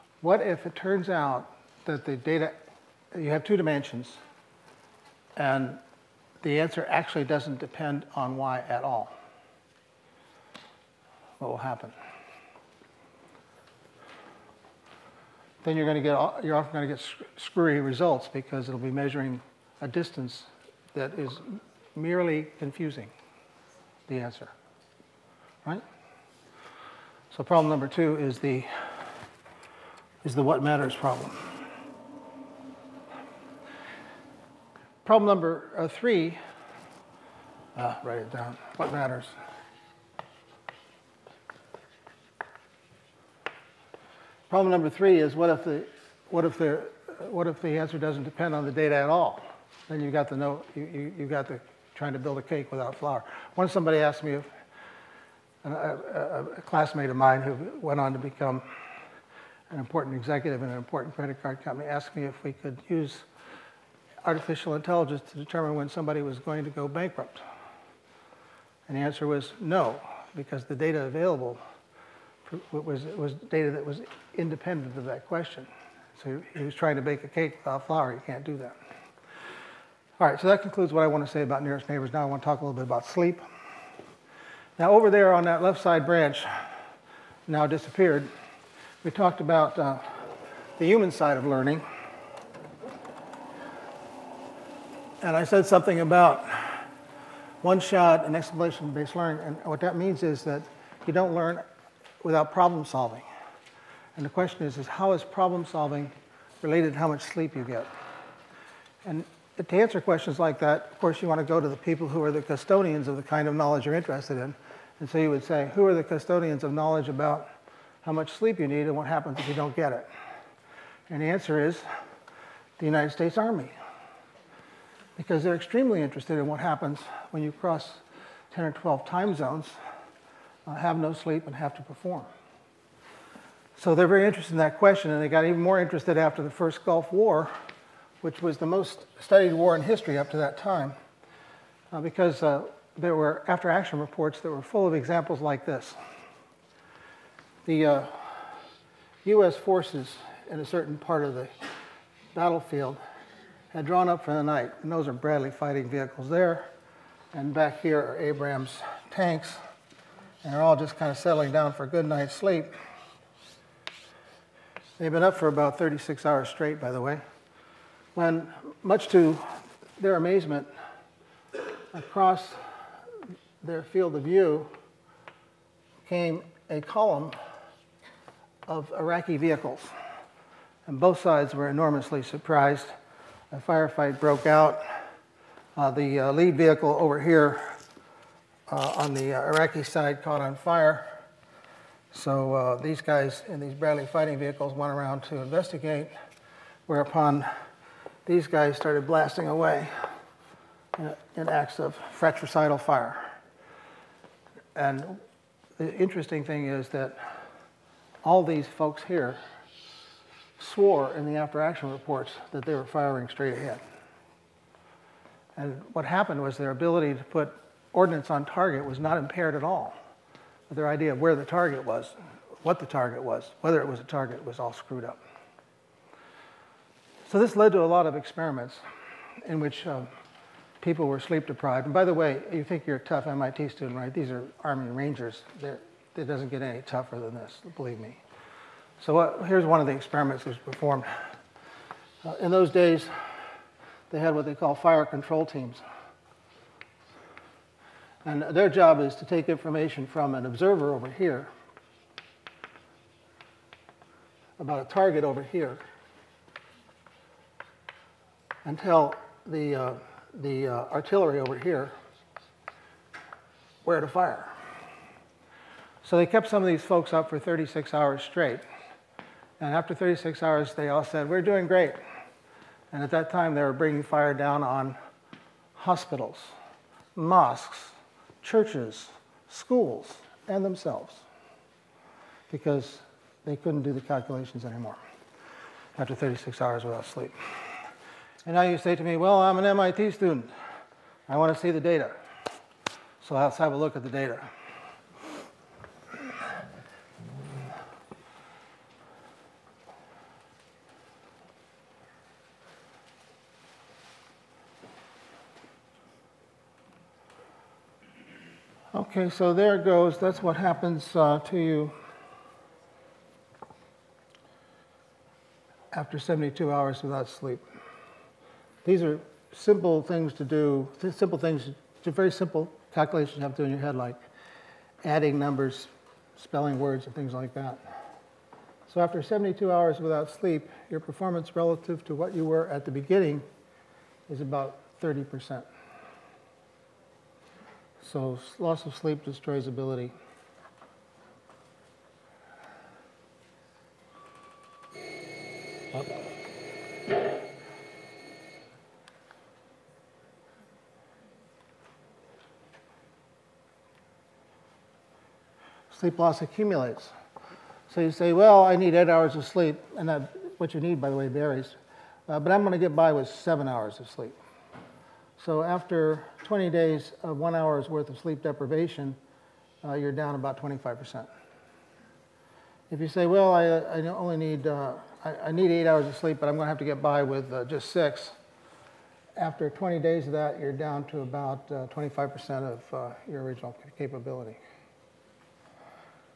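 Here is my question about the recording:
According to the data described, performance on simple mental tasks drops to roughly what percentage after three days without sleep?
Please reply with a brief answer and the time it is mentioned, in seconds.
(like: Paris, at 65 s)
30%, at 335 s.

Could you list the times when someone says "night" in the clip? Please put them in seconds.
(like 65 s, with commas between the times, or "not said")
154 s, 162 s.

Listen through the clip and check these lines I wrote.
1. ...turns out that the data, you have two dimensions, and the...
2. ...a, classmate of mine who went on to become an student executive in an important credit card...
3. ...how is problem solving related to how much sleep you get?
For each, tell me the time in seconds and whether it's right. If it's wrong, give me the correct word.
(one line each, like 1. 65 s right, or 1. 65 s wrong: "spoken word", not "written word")
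1. 0 s right
2. 56 s wrong: "important", not "student"
3. 104 s right.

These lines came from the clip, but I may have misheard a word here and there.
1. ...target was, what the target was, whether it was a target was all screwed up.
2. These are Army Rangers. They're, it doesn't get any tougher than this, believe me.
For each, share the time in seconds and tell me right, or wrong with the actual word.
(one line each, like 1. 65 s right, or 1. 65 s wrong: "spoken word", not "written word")
1. 221 s right
2. 234 s right.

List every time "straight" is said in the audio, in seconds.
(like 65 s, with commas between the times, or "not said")
166 s, 213 s, 268 s.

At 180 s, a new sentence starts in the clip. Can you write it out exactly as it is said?
And both sides were enormously surprised.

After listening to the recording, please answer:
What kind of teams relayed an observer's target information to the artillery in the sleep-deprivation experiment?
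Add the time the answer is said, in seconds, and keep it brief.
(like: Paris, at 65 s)
fire control teams, at 244 s.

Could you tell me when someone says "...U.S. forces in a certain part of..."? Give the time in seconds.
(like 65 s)
149 s.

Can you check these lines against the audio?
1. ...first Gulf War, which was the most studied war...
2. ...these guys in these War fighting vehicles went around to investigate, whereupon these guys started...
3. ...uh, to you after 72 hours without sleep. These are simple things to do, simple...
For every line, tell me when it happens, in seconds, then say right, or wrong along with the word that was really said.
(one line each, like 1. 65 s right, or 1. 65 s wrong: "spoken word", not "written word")
1. 136 s right
2. 192 s wrong: "Bradley", not "War"
3. 311 s right.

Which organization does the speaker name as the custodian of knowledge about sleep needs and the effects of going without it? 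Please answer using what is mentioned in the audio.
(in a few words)
United States Army.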